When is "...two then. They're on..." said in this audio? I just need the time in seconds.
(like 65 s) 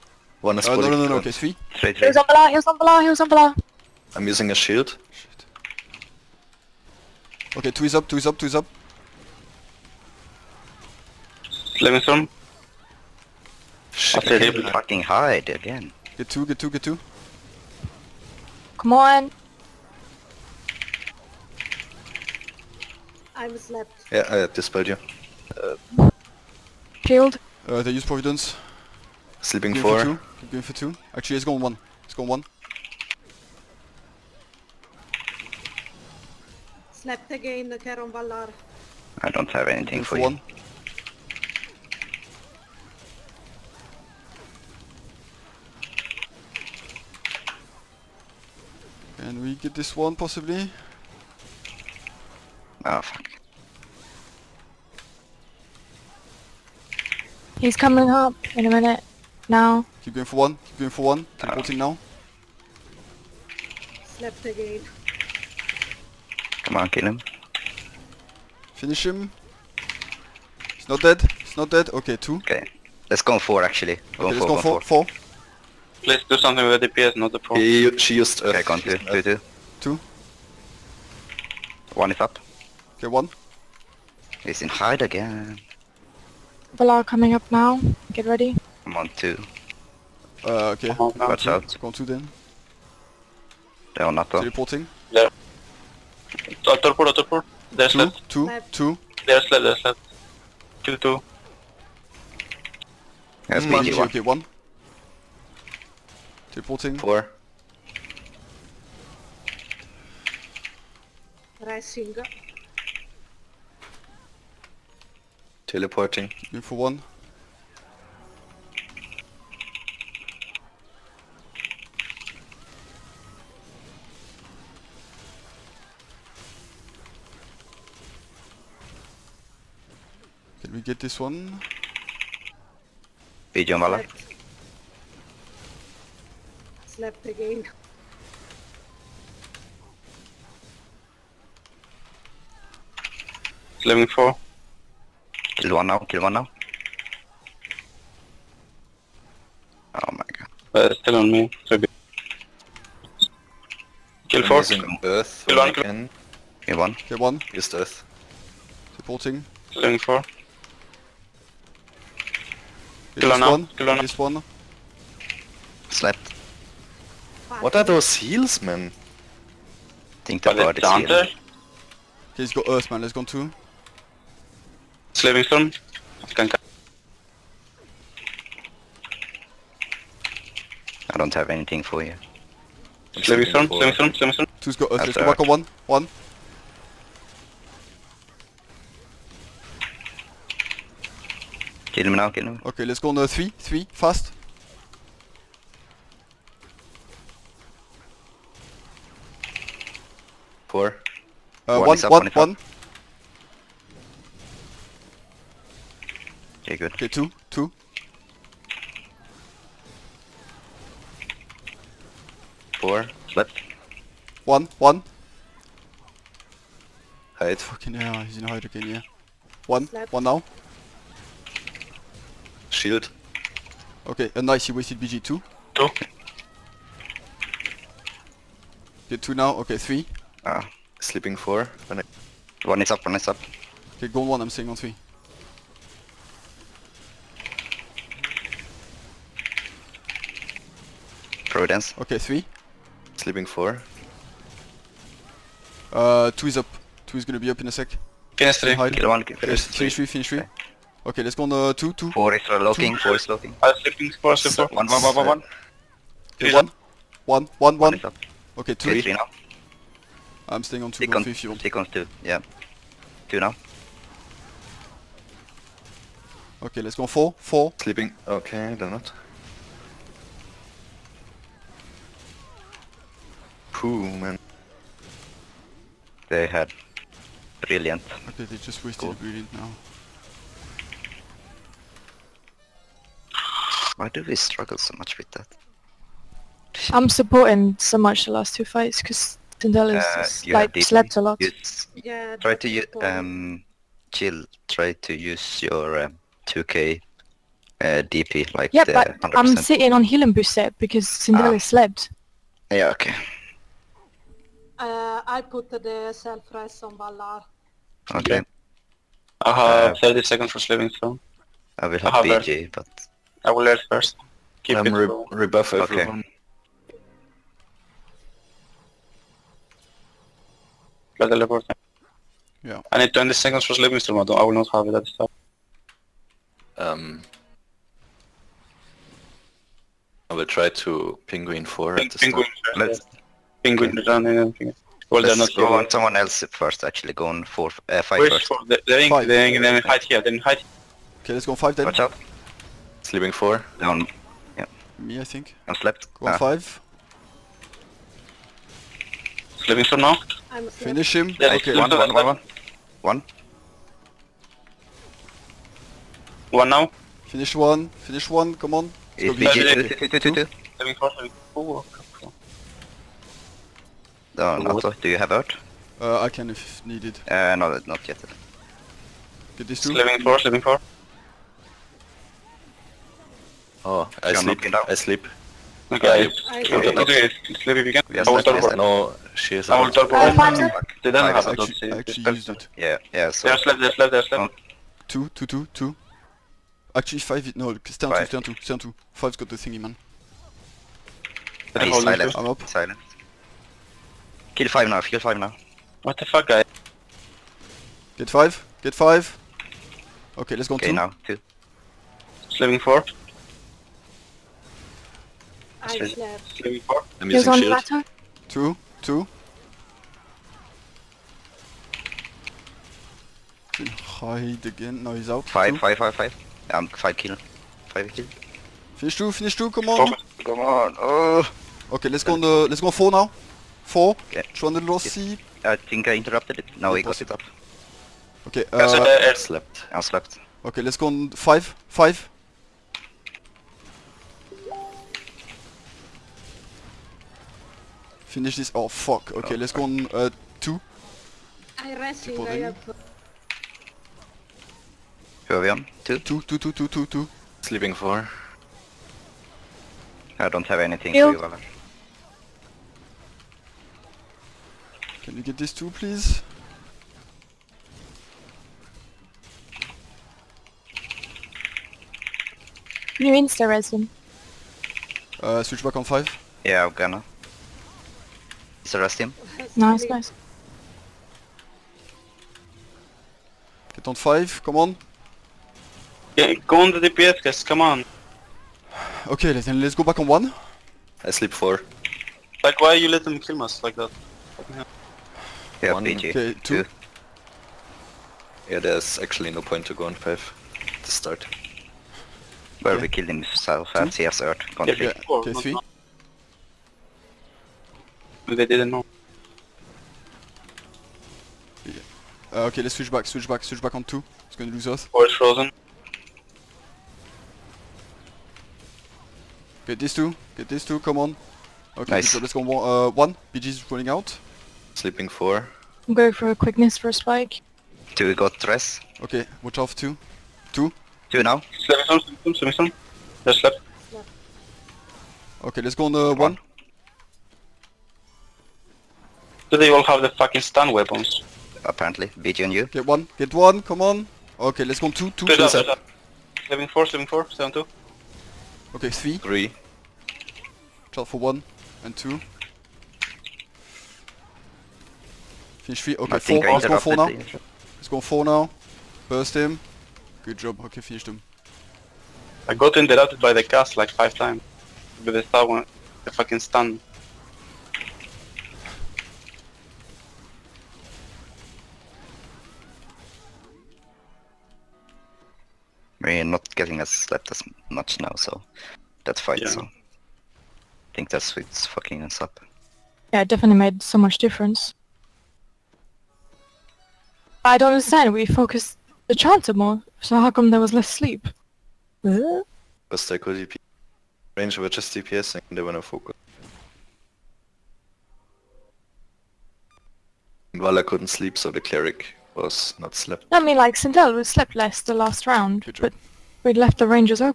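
91 s.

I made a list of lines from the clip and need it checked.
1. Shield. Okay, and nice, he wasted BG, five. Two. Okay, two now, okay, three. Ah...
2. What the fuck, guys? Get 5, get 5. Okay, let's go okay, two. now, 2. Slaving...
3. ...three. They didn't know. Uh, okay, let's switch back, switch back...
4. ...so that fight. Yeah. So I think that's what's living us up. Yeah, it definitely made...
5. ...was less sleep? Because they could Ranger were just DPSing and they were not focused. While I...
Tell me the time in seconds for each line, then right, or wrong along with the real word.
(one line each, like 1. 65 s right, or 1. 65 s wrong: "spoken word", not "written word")
1. 222 s wrong: "two", not "five"
2. 396 s right
3. 495 s right
4. 568 s wrong: "fucking", not "living"
5. 580 s right.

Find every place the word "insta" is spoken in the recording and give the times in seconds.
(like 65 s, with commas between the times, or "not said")
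463 s, 468 s.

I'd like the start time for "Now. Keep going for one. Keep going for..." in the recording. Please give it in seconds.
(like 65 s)
59 s.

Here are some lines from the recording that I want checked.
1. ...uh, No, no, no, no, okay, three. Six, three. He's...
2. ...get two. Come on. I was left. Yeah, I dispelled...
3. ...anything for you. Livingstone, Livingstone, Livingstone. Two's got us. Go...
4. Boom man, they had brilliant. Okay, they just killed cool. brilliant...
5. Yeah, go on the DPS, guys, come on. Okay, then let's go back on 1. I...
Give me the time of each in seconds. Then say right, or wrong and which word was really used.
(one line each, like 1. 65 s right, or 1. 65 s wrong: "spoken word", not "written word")
1. 0 s wrong: "Three", not "Six"
2. 16 s right
3. 181 s right
4. 273 s wrong: "wasted", not "killed"
5. 476 s right.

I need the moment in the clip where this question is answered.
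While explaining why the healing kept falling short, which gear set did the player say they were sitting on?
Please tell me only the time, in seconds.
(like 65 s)
300 s.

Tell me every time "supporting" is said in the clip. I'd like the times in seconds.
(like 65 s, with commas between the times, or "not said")
158 s, 287 s.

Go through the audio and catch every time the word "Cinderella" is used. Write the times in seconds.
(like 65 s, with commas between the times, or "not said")
289 s, 301 s.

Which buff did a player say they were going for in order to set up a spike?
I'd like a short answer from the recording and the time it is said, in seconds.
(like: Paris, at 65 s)
quickness, at 516 s.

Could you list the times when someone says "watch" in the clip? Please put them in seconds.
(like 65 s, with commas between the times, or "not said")
91 s, 341 s, 519 s.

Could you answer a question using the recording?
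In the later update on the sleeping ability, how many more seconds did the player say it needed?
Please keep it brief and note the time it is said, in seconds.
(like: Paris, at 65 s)
20 seconds, at 323 s.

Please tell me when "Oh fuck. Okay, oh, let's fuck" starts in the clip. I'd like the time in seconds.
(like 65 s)
438 s.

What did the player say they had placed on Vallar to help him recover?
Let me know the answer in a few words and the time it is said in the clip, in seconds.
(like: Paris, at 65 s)
self-res, at 306 s.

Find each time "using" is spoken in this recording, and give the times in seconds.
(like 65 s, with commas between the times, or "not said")
4 s, 407 s.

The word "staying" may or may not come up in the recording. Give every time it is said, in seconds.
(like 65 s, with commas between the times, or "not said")
234 s, 260 s.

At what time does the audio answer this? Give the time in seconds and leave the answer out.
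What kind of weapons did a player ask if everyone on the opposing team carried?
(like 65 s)
530 s.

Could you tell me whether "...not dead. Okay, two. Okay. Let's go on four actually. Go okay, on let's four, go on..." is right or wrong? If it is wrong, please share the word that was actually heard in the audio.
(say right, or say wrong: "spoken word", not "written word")
right.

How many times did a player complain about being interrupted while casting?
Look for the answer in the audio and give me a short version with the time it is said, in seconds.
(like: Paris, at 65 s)
5 times, at 554 s.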